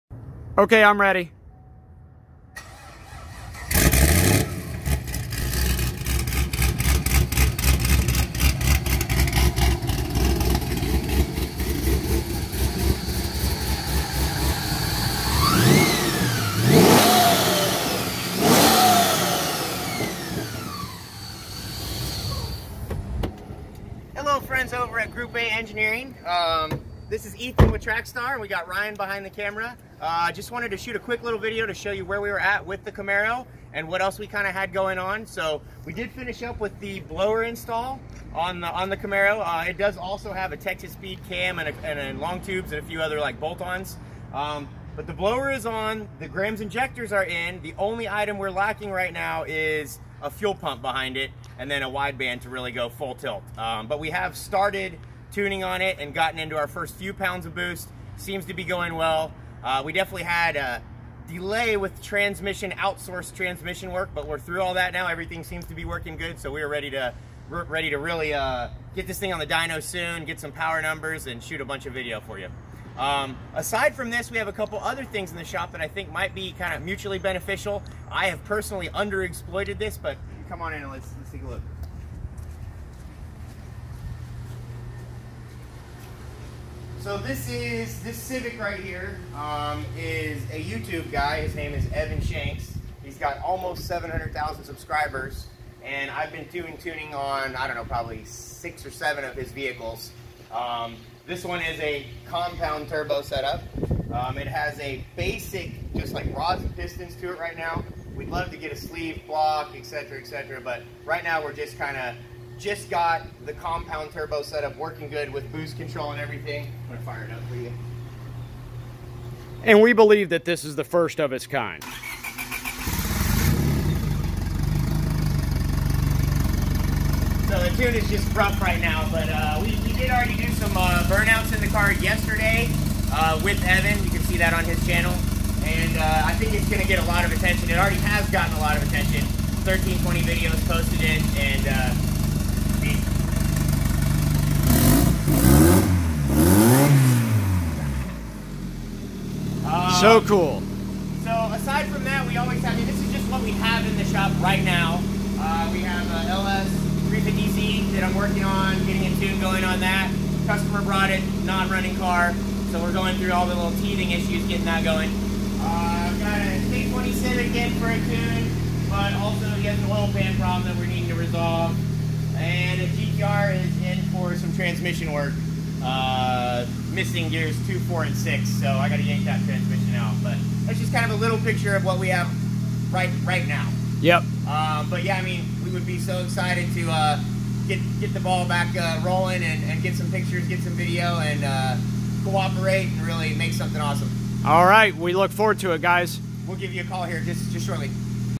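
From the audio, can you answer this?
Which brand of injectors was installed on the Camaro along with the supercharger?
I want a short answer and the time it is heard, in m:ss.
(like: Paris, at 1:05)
Grams, at 0:46.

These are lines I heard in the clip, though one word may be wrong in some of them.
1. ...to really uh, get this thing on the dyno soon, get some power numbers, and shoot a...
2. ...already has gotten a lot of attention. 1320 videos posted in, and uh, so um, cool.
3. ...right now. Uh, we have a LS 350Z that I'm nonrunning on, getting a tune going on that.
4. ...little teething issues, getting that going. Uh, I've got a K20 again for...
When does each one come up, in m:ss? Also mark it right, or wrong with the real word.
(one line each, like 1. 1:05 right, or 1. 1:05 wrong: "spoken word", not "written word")
1. 1:07 right
2. 2:17 right
3. 2:34 wrong: "working", not "nonrunning"
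4. 2:43 right.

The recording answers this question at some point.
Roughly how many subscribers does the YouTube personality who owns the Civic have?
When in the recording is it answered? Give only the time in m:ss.
1:33.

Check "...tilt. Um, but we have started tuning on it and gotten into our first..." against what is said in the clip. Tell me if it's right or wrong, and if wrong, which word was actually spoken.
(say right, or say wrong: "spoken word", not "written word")
right.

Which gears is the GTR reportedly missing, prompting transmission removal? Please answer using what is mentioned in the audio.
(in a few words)
2, 4, and 6.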